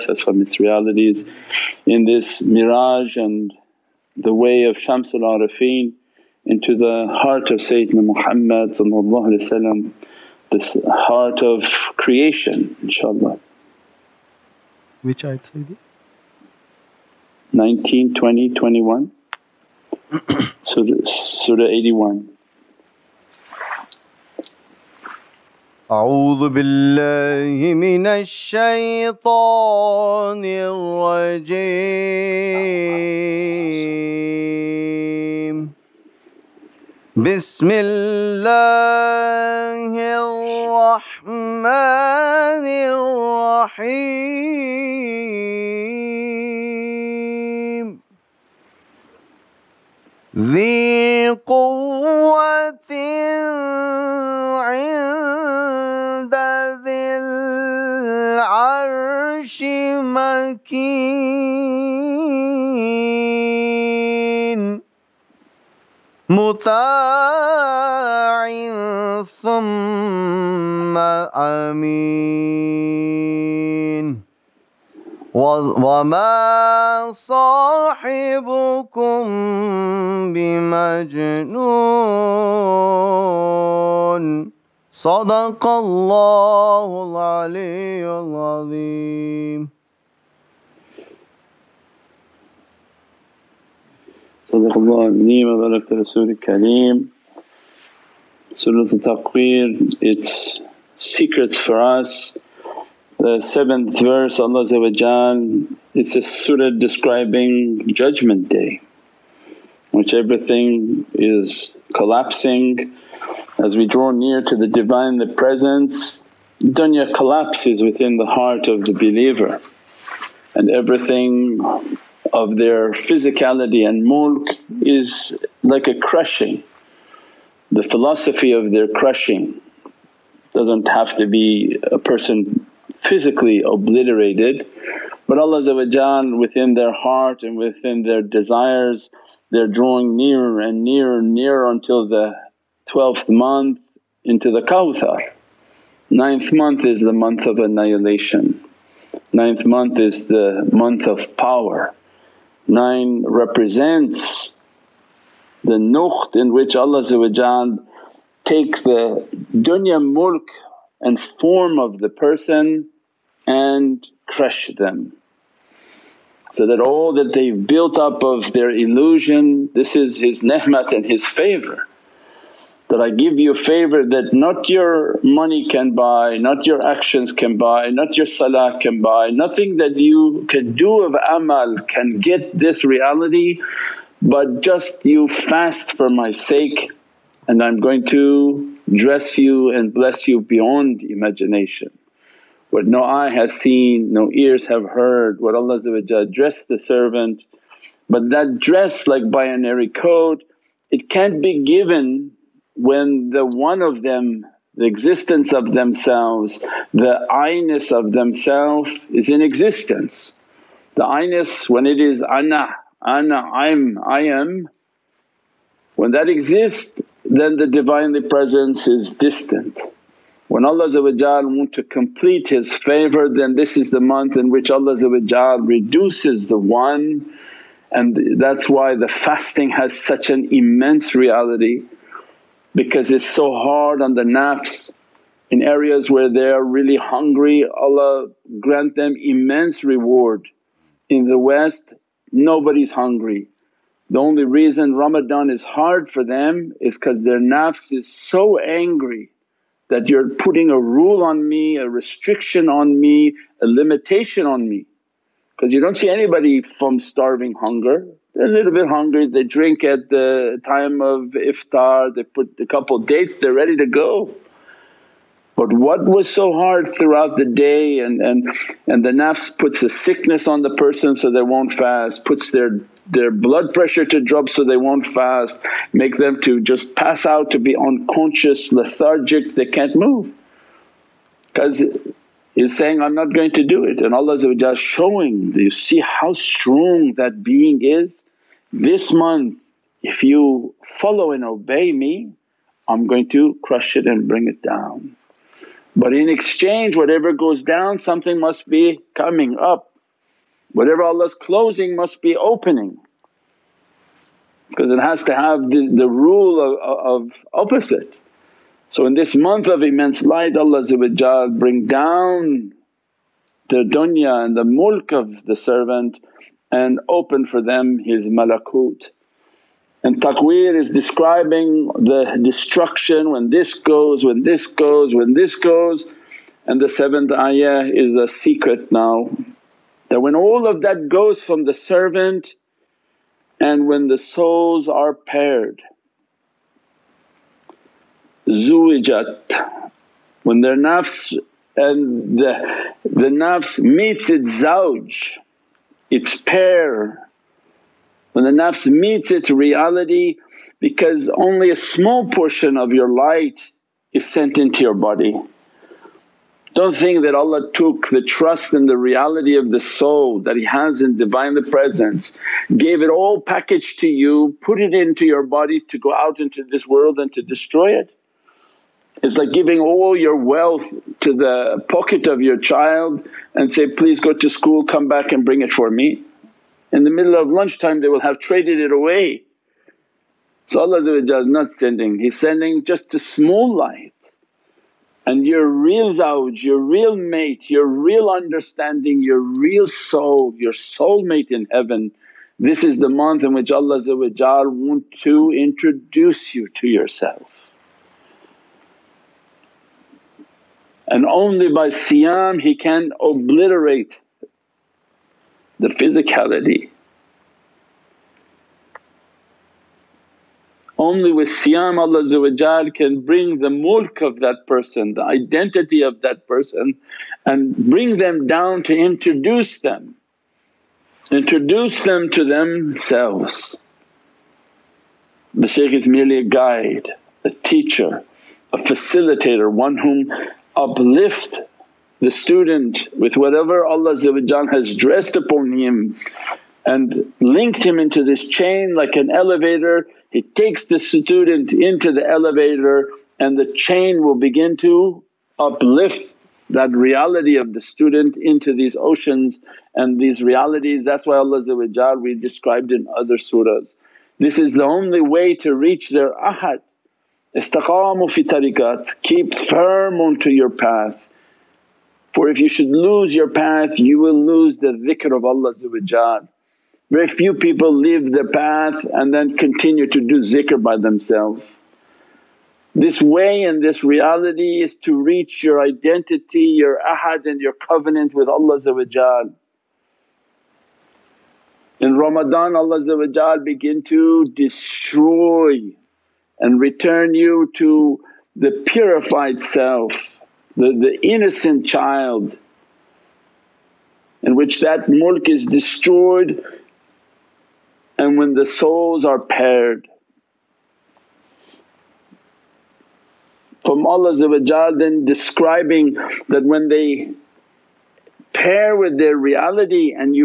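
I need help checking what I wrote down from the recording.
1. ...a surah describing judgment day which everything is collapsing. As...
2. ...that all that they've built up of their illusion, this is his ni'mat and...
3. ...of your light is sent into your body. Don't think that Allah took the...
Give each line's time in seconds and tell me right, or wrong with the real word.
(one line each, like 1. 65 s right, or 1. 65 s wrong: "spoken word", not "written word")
1. 106 s right
2. 166 s right
3. 352 s right.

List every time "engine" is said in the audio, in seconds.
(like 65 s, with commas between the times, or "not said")
not said.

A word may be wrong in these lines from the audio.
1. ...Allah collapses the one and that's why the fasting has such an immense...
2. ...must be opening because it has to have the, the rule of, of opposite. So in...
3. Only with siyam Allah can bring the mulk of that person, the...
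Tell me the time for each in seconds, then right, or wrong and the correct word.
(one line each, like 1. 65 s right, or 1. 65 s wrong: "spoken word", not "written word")
1. 224 s wrong: "reduces", not "collapses"
2. 301 s right
3. 410 s right.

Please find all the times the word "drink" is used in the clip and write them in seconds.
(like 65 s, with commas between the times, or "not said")
259 s.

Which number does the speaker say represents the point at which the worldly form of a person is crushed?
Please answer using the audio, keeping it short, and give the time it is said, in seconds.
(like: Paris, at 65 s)
Nine, at 152 s.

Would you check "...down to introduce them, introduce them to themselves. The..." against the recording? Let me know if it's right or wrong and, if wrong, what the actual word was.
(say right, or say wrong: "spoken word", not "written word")
right.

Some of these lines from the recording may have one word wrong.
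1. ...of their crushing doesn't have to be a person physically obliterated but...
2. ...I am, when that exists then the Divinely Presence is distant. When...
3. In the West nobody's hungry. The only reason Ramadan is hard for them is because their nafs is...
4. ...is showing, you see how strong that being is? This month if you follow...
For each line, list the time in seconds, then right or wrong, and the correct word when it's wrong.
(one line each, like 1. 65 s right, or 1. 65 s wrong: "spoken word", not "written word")
1. 128 s right
2. 214 s right
3. 241 s right
4. 284 s right.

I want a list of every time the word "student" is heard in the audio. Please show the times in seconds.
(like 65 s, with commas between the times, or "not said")
432 s, 440 s, 447 s.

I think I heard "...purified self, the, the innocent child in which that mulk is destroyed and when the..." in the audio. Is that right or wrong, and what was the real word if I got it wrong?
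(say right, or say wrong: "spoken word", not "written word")
right.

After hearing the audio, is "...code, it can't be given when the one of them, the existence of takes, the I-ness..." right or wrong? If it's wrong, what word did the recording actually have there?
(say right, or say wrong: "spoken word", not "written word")
wrong: "themselves", not "takes".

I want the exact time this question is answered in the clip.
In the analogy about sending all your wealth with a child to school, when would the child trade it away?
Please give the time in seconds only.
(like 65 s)
377 s.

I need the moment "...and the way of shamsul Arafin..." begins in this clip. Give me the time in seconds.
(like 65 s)
3 s.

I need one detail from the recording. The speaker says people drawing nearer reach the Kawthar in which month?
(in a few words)
12th month.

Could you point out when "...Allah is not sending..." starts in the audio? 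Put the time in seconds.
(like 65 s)
380 s.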